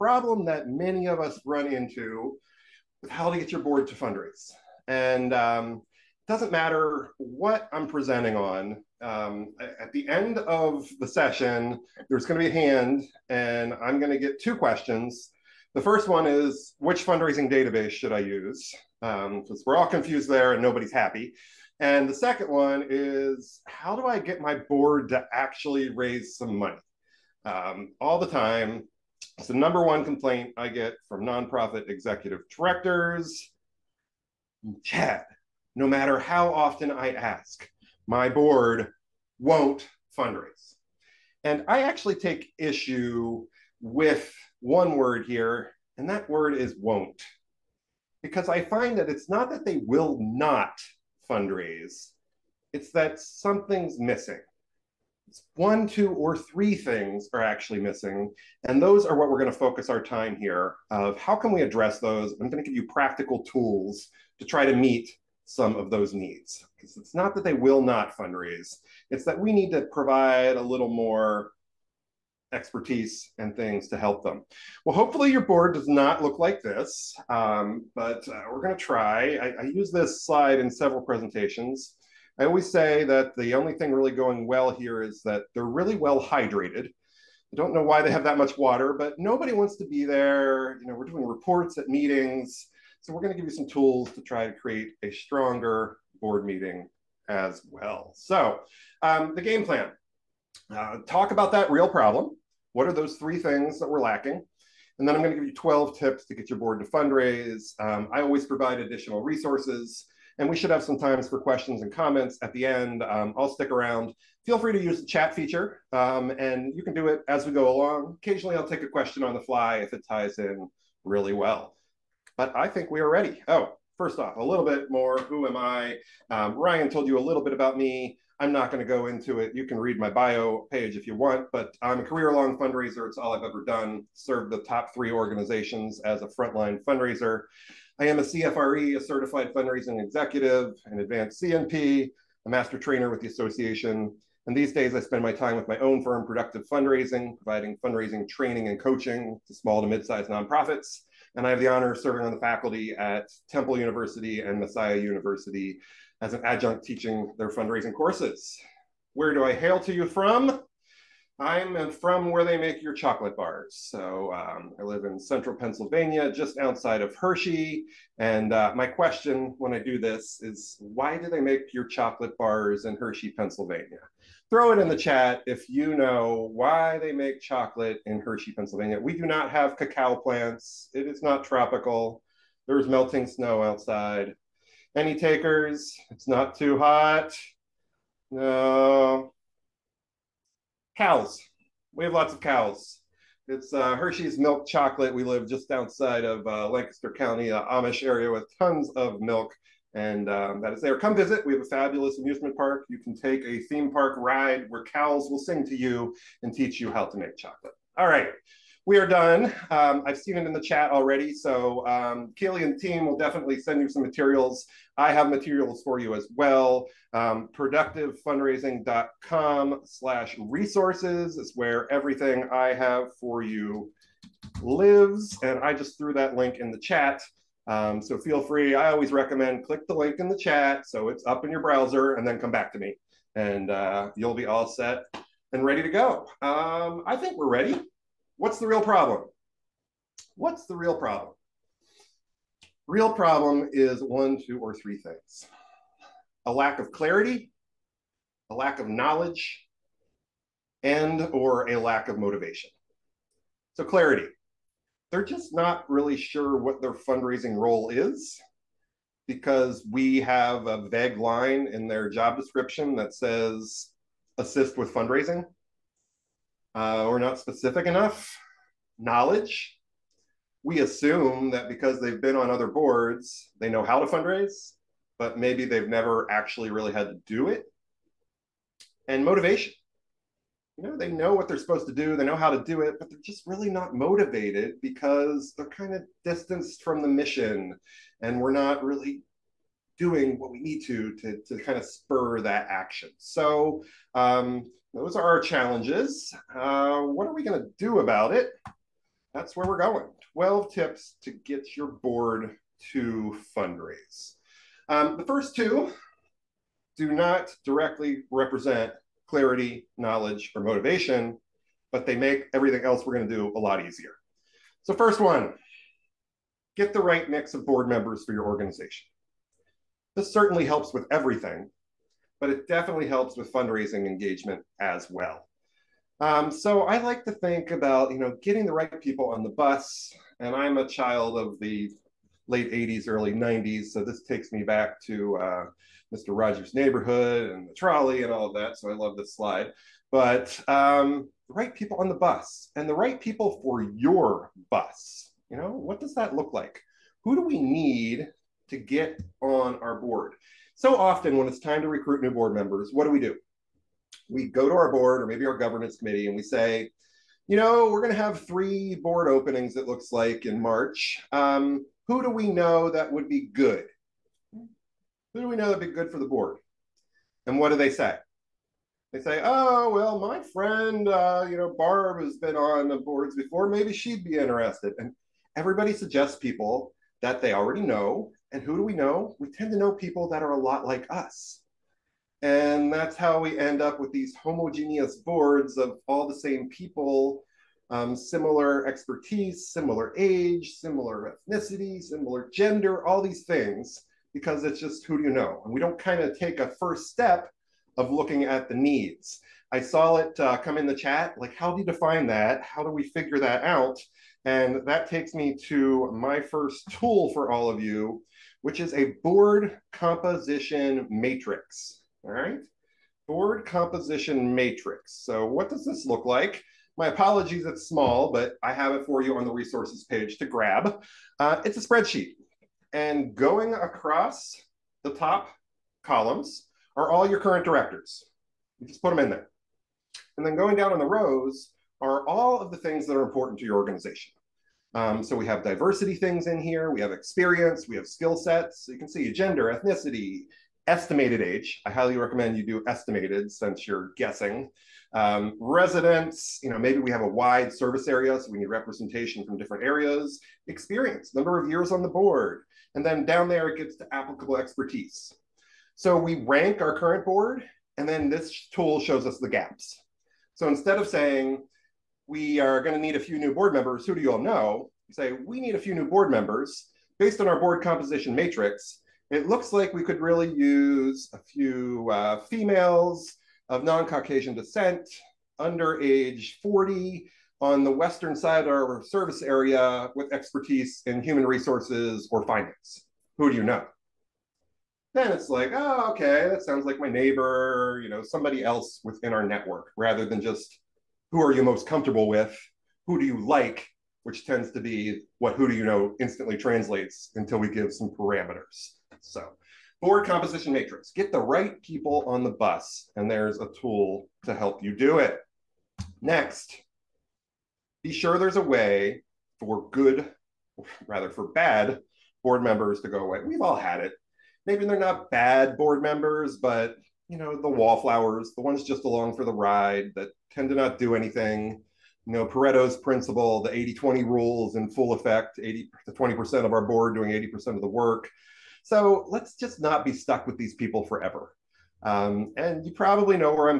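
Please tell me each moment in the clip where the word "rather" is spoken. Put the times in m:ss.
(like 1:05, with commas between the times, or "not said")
8:09, 8:31.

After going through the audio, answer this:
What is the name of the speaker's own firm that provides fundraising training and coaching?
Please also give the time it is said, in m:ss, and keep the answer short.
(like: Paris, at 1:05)
Productive Fundraising, at 2:26.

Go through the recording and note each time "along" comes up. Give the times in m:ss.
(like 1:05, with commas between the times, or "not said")
1:57, 8:39.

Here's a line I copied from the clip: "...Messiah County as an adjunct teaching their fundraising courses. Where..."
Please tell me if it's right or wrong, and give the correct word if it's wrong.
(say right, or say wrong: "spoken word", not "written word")
wrong: "University", not "County".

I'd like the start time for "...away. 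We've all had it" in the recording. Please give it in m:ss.
8:33.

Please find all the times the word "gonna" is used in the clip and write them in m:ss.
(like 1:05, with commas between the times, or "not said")
1:18, 7:42.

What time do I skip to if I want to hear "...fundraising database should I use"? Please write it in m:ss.
0:17.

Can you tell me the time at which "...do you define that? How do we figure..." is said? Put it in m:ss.
6:41.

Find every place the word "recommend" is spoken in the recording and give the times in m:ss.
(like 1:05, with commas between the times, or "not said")
3:49, 7:22.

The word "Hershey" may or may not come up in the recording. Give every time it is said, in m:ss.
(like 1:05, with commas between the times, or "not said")
2:47, 2:52, 2:58, 3:13.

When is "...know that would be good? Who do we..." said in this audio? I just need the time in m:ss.
6:02.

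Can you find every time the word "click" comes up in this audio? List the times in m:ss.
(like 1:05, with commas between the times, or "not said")
3:49.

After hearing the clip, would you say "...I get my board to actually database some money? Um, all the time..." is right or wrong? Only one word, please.
wrong.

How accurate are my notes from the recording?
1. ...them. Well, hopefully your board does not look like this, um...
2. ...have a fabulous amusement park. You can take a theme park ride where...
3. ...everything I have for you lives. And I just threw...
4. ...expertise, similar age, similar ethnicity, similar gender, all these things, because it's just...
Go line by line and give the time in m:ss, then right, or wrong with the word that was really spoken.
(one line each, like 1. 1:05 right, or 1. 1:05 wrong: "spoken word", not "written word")
1. 1:14 right
2. 3:21 right
3. 3:41 right
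4. 6:28 right.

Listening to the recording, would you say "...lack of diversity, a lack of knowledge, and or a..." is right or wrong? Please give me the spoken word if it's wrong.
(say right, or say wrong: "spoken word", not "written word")
wrong: "clarity", not "diversity".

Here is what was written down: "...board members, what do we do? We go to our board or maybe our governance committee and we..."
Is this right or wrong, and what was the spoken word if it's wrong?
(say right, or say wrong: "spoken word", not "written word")
right.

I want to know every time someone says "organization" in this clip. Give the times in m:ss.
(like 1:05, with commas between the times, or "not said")
2:15, 5:18, 7:13.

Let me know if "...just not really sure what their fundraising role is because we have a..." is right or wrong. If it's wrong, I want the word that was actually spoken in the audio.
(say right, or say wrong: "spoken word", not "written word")
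right.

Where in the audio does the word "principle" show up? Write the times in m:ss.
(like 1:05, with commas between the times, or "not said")
8:42.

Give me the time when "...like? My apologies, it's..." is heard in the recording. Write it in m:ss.
6:56.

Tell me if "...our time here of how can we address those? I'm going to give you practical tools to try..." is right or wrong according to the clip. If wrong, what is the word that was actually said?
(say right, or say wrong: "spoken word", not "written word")
right.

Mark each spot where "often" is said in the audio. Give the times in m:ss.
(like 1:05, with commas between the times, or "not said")
0:36, 5:50.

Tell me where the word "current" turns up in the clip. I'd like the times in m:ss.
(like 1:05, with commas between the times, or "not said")
7:07, 7:36.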